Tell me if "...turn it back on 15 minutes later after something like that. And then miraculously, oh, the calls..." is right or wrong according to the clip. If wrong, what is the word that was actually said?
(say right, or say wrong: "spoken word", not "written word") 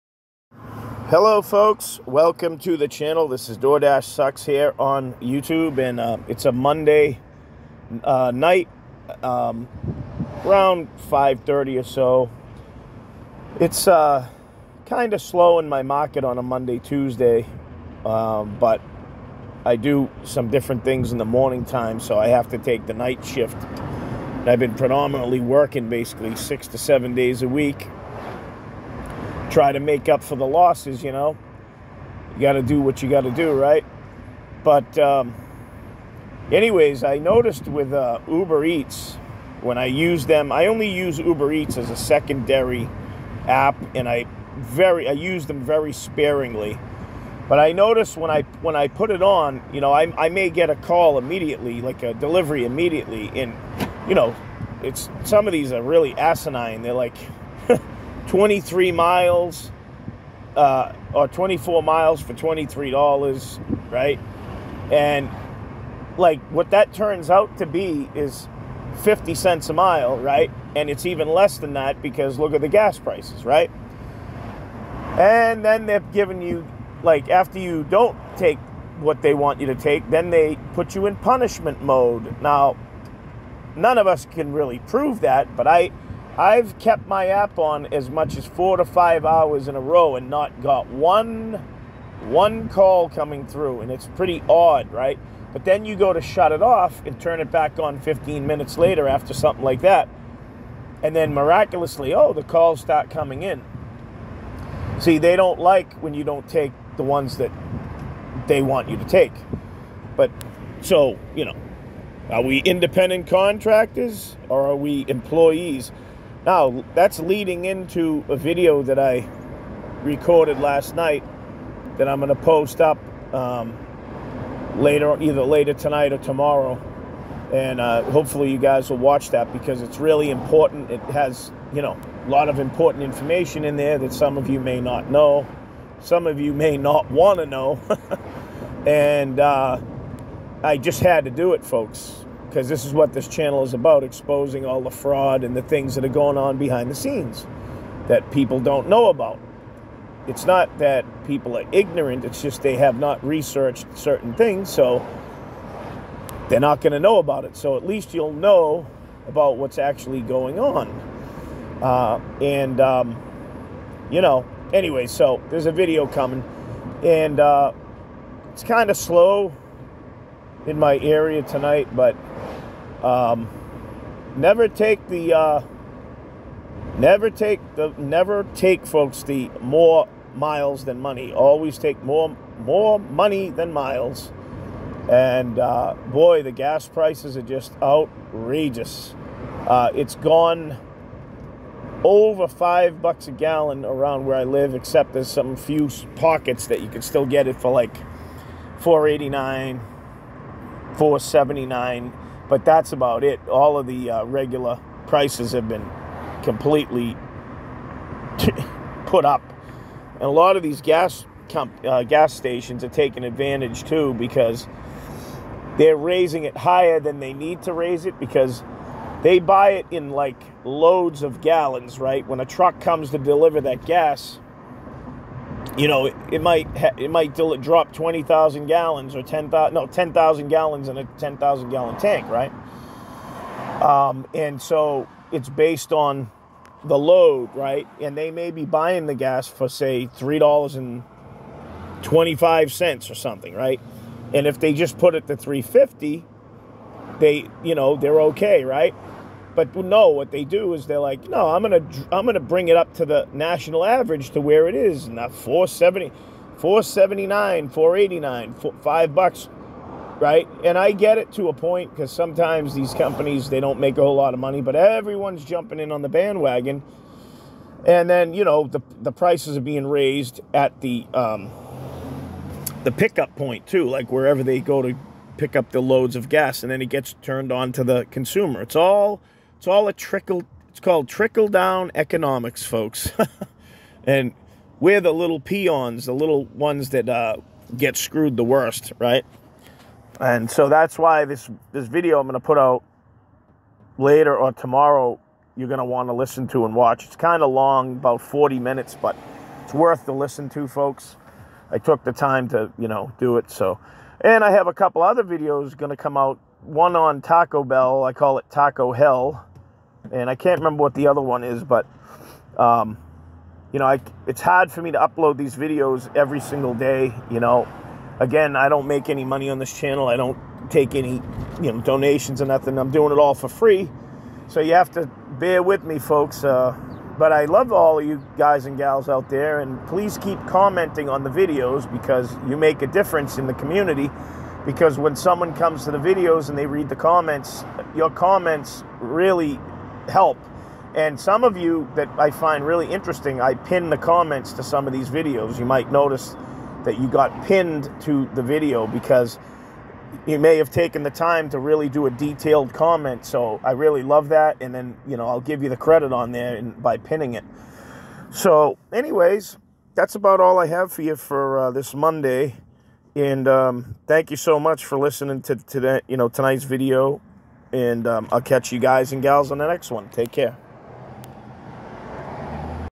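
right.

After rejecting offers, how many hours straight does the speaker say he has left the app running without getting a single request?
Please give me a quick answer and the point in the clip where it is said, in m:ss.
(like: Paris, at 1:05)
4 to 5 hours, at 1:28.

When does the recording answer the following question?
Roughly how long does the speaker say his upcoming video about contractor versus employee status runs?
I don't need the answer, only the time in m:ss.
4:58.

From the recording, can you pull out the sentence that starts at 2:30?
It's not that people are ignorant, it's just they have not researched certain things, so they're not going to know about it.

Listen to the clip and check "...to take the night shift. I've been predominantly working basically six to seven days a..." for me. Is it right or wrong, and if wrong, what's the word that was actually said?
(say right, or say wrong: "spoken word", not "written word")
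right.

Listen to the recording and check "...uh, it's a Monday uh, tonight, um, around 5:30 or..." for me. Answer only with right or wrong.
wrong.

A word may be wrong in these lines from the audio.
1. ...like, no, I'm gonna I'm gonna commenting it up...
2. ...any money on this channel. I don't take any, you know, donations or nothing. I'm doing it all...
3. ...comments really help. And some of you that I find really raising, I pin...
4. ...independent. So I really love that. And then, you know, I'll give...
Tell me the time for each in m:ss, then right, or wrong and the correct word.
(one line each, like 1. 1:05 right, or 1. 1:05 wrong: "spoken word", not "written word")
1. 4:10 wrong: "bring", not "commenting"
2. 5:19 right
3. 5:38 wrong: "interesting", not "raising"
4. 5:52 wrong: "comment", not "independent".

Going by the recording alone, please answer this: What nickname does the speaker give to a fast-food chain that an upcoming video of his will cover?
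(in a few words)
Taco Hell.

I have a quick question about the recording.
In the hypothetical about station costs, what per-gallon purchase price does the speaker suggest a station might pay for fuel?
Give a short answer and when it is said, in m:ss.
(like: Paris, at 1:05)
$3.25, at 4:00.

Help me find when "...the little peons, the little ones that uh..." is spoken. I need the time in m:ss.
4:45.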